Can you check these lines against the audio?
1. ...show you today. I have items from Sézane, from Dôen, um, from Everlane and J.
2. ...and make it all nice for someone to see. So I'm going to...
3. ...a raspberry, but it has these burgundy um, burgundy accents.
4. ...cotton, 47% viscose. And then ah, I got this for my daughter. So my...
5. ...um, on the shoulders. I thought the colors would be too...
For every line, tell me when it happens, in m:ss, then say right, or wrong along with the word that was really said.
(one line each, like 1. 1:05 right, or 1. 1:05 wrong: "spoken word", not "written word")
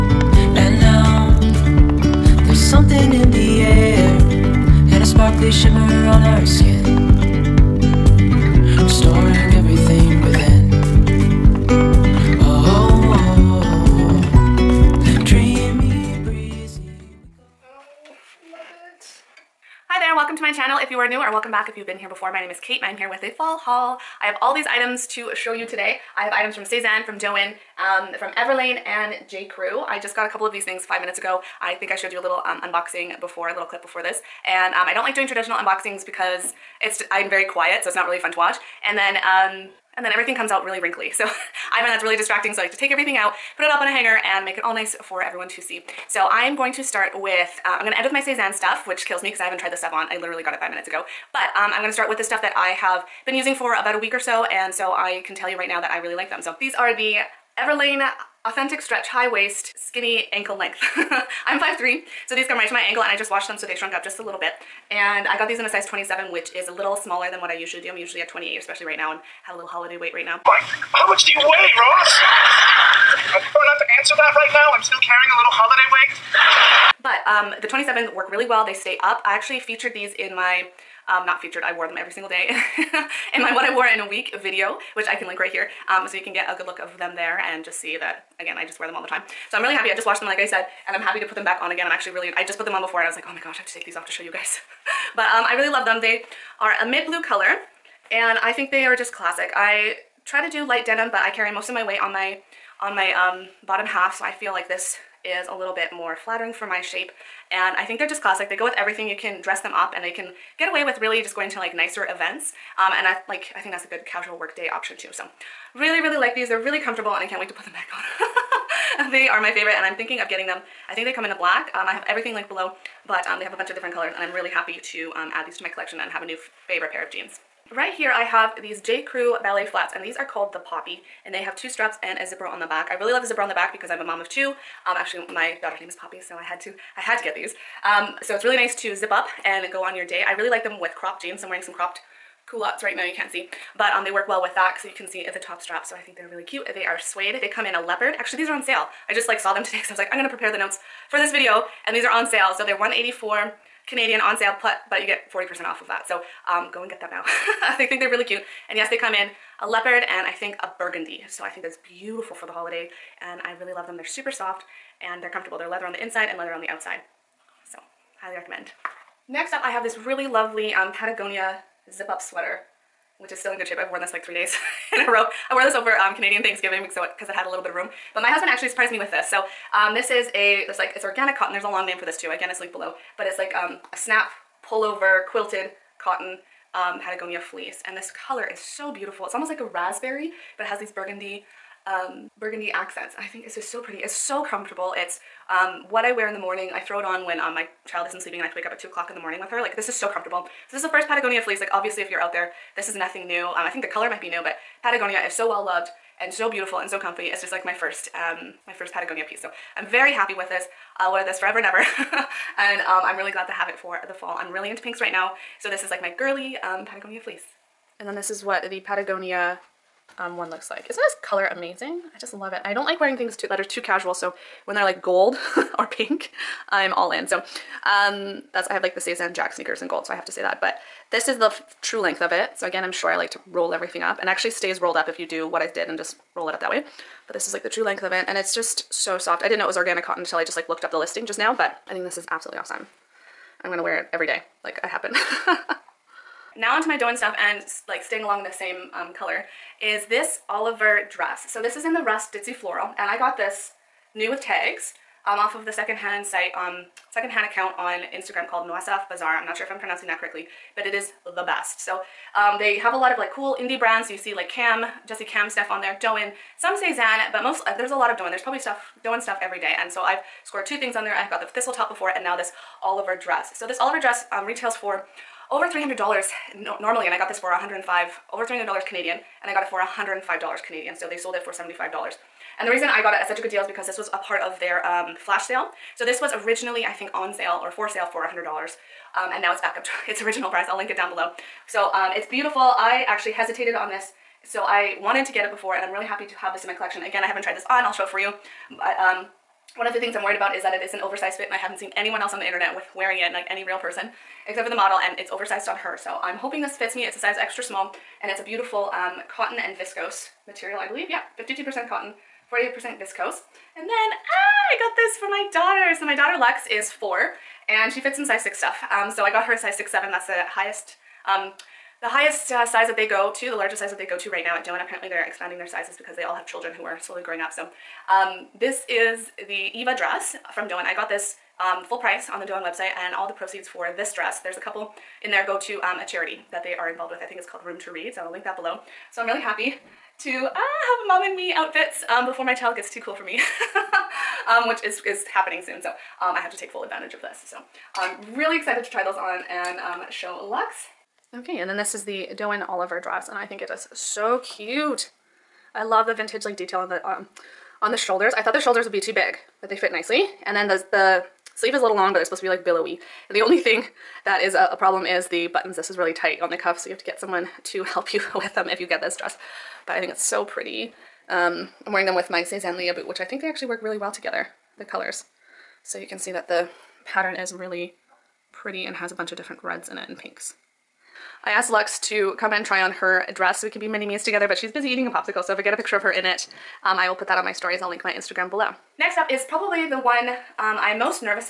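1. 0:25 right
2. 0:44 wrong: "everyone", not "someone"
3. 3:09 right
4. 5:11 wrong: "48", not "47"
5. 5:57 wrong: "shoulders", not "colors".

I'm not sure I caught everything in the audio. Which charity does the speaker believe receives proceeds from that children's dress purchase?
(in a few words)
Room to Read.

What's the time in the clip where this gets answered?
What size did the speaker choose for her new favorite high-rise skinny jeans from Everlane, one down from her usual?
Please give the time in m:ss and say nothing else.
1:05.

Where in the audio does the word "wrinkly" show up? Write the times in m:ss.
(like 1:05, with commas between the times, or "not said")
0:40.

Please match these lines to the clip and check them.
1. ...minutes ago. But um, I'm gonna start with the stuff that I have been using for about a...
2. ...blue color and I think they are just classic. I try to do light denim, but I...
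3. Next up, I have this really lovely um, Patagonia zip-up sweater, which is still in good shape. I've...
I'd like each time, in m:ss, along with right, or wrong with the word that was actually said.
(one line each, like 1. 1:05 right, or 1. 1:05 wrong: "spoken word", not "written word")
1. 0:50 right
2. 1:37 right
3. 2:49 right.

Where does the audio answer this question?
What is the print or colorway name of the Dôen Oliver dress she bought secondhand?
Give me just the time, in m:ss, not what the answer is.
4:12.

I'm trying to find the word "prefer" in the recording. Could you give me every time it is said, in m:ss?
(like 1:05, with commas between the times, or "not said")
1:13.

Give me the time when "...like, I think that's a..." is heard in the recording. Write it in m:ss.
1:53.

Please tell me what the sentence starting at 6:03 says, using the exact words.
And the only thing that is a, a, problem is the buttons.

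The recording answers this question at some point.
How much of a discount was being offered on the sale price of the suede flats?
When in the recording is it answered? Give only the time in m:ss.
2:35.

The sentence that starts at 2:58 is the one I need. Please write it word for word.
But my husband actually surprised me with this.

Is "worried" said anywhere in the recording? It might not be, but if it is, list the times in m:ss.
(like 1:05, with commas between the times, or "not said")
5:00.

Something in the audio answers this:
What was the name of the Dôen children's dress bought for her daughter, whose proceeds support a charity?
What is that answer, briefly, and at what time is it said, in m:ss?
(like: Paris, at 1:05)
Eva, at 5:29.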